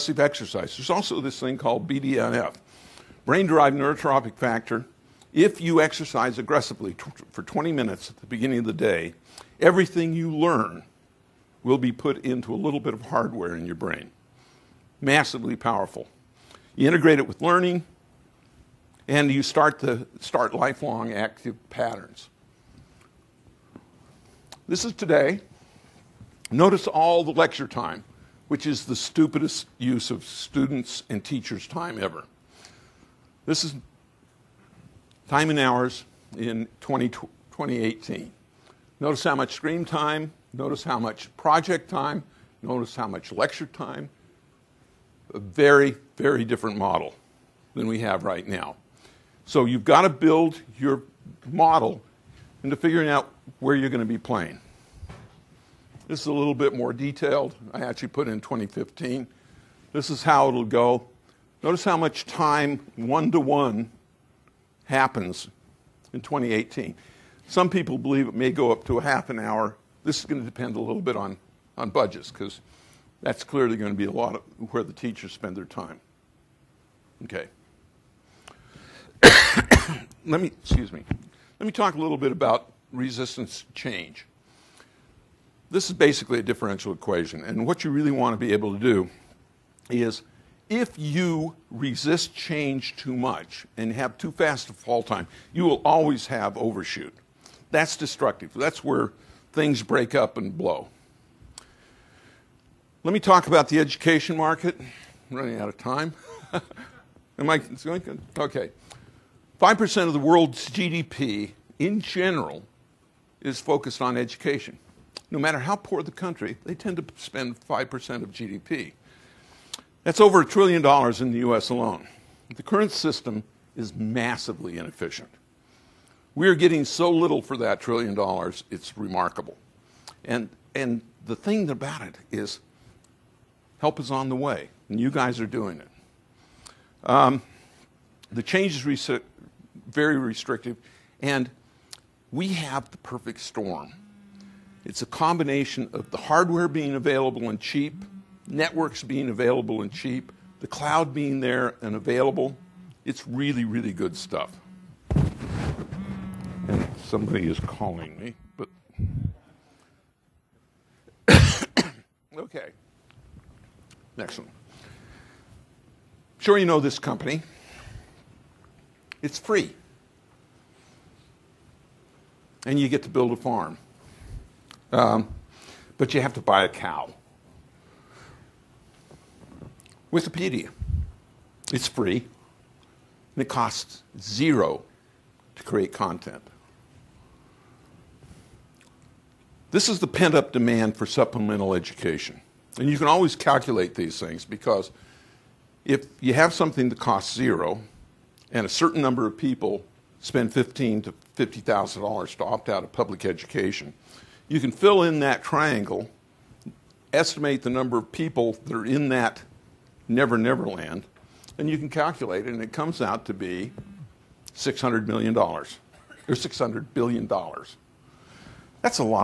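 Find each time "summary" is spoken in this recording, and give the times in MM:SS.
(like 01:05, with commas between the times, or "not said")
not said.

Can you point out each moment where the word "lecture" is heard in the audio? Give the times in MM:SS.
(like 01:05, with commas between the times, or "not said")
00:27, 00:43.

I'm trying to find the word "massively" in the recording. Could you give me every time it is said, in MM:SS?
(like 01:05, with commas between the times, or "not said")
00:15, 02:03.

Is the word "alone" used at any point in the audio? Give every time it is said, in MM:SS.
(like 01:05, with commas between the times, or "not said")
02:01.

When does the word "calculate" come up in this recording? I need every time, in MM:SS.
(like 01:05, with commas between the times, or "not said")
03:13, 03:31.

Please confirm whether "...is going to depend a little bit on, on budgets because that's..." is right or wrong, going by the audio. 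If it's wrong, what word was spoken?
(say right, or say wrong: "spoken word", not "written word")
right.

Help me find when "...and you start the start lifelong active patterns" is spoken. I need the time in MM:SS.
00:19.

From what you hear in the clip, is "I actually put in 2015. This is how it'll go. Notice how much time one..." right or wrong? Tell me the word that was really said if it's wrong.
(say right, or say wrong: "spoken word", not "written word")
right.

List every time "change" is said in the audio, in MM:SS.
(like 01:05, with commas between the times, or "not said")
01:23, 01:32, 02:18.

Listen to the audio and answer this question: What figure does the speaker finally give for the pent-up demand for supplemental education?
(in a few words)
$600 billion.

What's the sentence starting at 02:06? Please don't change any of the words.
We are getting so little for that trillion dollars, it's remarkable.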